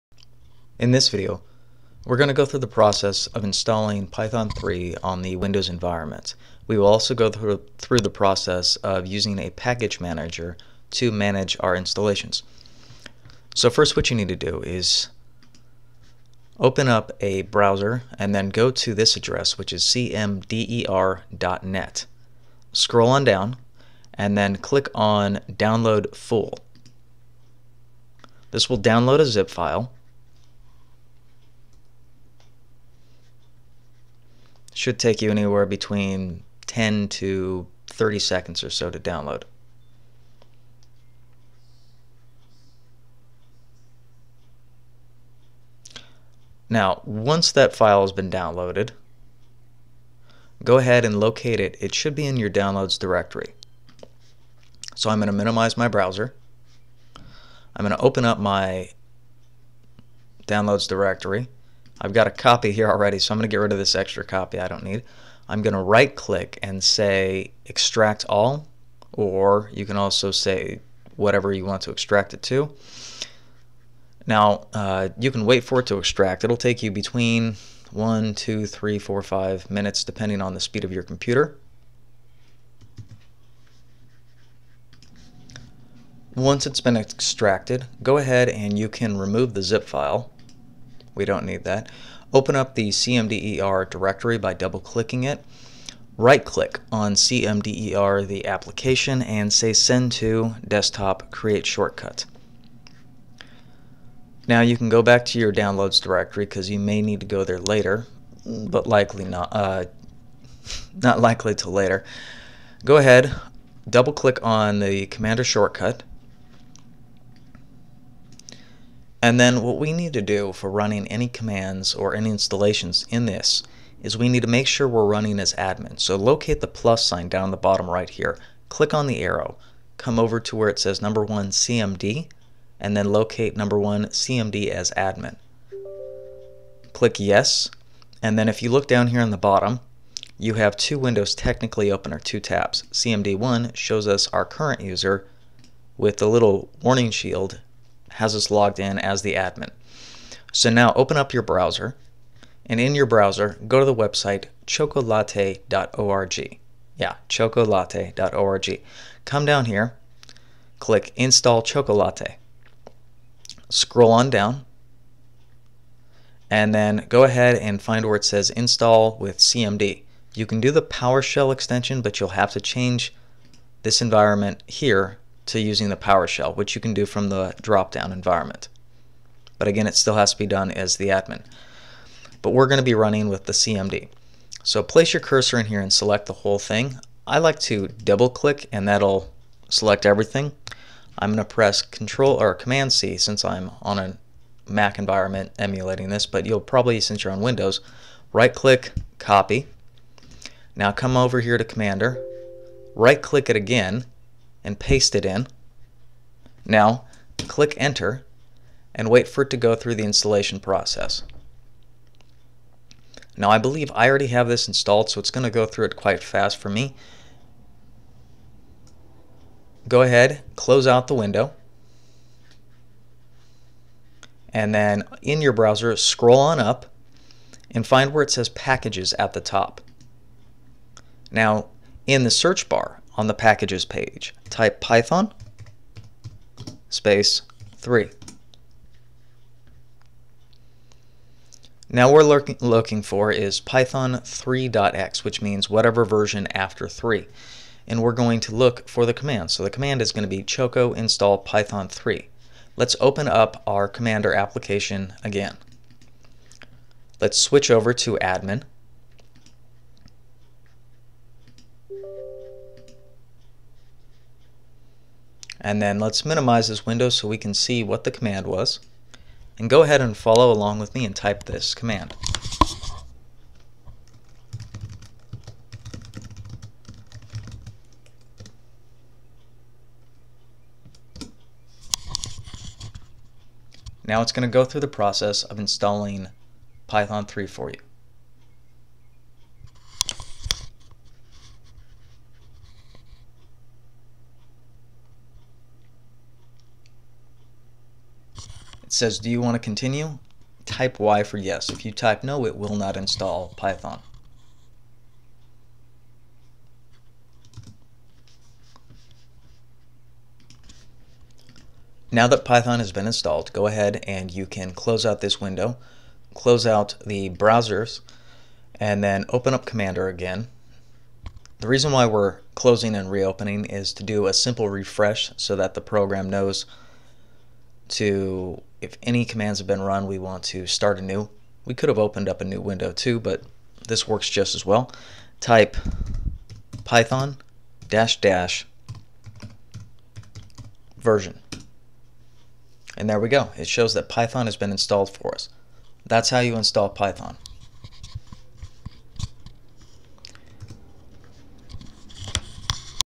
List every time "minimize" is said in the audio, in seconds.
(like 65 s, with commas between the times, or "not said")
55 s, 266 s.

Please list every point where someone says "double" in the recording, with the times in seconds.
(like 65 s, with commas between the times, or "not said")
94 s, 113 s, 187 s.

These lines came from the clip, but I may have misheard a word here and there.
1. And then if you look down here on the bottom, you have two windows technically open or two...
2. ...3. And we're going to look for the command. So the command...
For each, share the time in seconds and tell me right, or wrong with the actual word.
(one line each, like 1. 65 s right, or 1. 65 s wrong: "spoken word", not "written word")
1. 138 s right
2. 246 s right.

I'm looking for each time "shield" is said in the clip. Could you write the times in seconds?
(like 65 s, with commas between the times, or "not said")
147 s.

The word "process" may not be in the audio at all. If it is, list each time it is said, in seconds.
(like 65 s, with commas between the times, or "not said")
2 s, 8 s, 210 s, 284 s.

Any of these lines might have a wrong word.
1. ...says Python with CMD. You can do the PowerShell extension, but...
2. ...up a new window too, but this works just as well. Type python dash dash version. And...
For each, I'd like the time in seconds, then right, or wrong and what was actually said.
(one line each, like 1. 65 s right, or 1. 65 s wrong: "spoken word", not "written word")
1. 168 s wrong: "Install", not "Python"
2. 332 s right.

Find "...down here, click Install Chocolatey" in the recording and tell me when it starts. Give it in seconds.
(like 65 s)
159 s.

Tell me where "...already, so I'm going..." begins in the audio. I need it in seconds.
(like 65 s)
62 s.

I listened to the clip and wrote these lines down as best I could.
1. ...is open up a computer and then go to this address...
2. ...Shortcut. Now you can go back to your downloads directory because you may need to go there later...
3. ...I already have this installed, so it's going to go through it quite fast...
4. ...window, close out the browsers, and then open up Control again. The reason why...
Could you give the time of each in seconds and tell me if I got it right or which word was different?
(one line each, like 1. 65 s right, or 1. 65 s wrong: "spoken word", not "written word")
1. 14 s wrong: "browser", not "computer"
2. 101 s right
3. 213 s right
4. 315 s wrong: "Commander", not "Control".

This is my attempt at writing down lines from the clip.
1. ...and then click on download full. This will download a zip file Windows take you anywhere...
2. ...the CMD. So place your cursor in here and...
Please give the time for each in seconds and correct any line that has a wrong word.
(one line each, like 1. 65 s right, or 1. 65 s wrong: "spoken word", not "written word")
1. 24 s wrong: "Should", not "Windows"
2. 183 s right.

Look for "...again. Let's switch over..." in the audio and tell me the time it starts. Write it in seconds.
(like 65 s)
255 s.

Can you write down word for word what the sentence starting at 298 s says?
It says, do you want to continue?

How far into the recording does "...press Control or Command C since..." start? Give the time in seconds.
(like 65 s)
191 s.